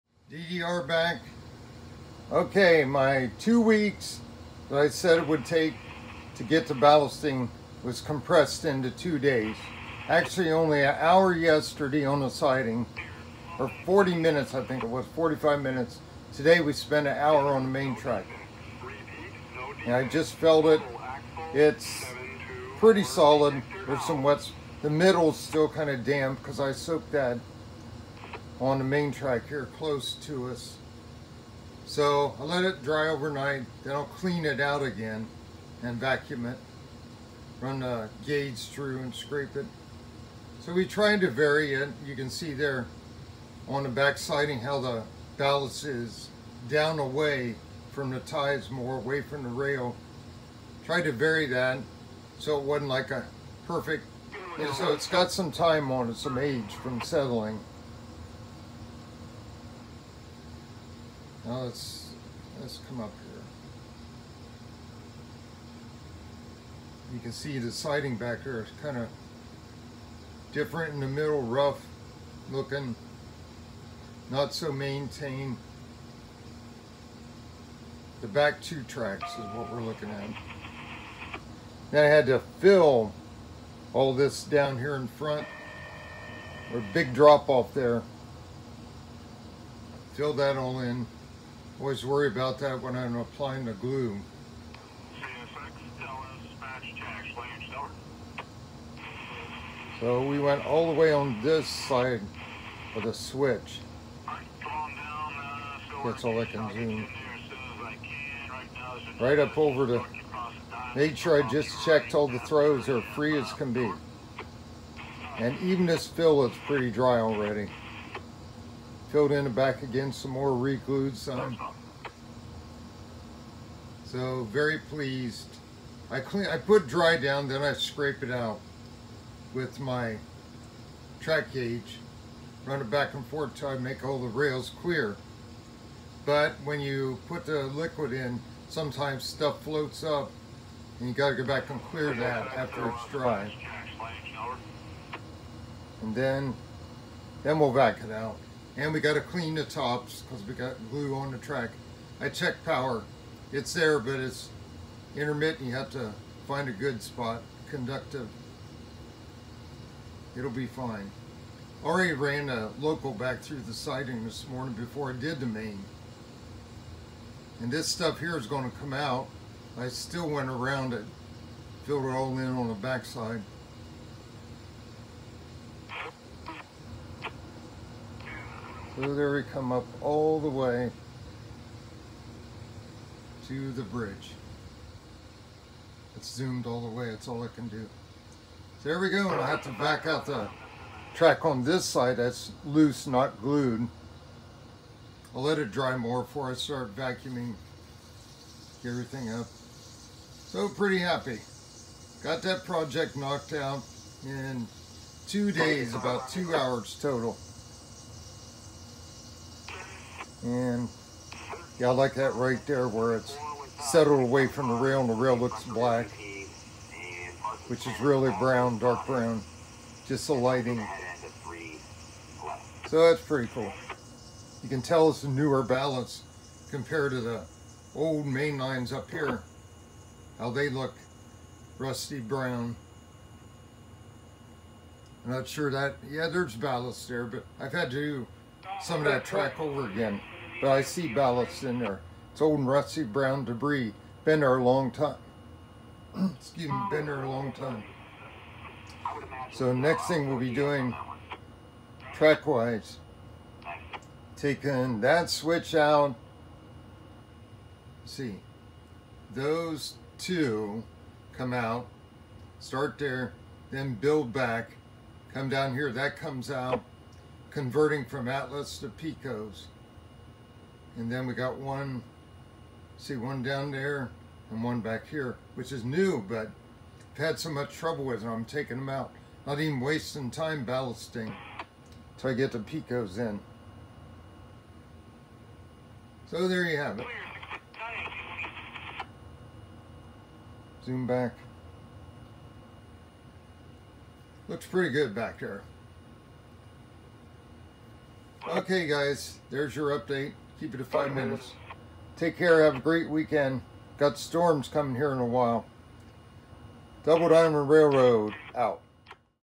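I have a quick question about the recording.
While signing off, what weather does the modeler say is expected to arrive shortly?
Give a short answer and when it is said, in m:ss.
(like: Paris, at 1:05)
storms, at 5:04.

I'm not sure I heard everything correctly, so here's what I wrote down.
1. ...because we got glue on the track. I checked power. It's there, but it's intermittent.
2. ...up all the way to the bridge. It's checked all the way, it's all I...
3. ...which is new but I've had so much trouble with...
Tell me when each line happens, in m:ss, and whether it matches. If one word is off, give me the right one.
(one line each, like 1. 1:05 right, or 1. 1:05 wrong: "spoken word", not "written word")
1. 2:30 right
2. 2:59 wrong: "zoomed", not "checked"
3. 4:35 right.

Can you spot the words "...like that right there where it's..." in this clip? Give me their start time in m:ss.
3:31.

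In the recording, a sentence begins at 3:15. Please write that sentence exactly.
I'll let it dry more before I start vacuuming everything up.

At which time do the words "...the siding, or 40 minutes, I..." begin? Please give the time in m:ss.
0:12.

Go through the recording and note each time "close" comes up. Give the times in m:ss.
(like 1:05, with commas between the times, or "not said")
0:29.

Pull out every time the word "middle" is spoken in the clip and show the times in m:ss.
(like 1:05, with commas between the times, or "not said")
0:24, 1:11.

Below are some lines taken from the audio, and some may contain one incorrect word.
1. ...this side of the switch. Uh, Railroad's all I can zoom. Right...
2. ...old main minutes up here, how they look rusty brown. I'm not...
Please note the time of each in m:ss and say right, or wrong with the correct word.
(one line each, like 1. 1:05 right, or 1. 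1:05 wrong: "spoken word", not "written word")
1. 1:41 wrong: "That", not "Railroad"
2. 3:47 wrong: "lines", not "minutes".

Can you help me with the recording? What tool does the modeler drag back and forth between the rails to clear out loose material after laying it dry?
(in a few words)
track gauge.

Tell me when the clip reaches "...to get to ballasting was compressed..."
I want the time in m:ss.
0:06.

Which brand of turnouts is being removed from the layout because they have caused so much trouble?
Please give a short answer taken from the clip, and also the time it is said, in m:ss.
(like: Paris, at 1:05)
Atlas, at 4:28.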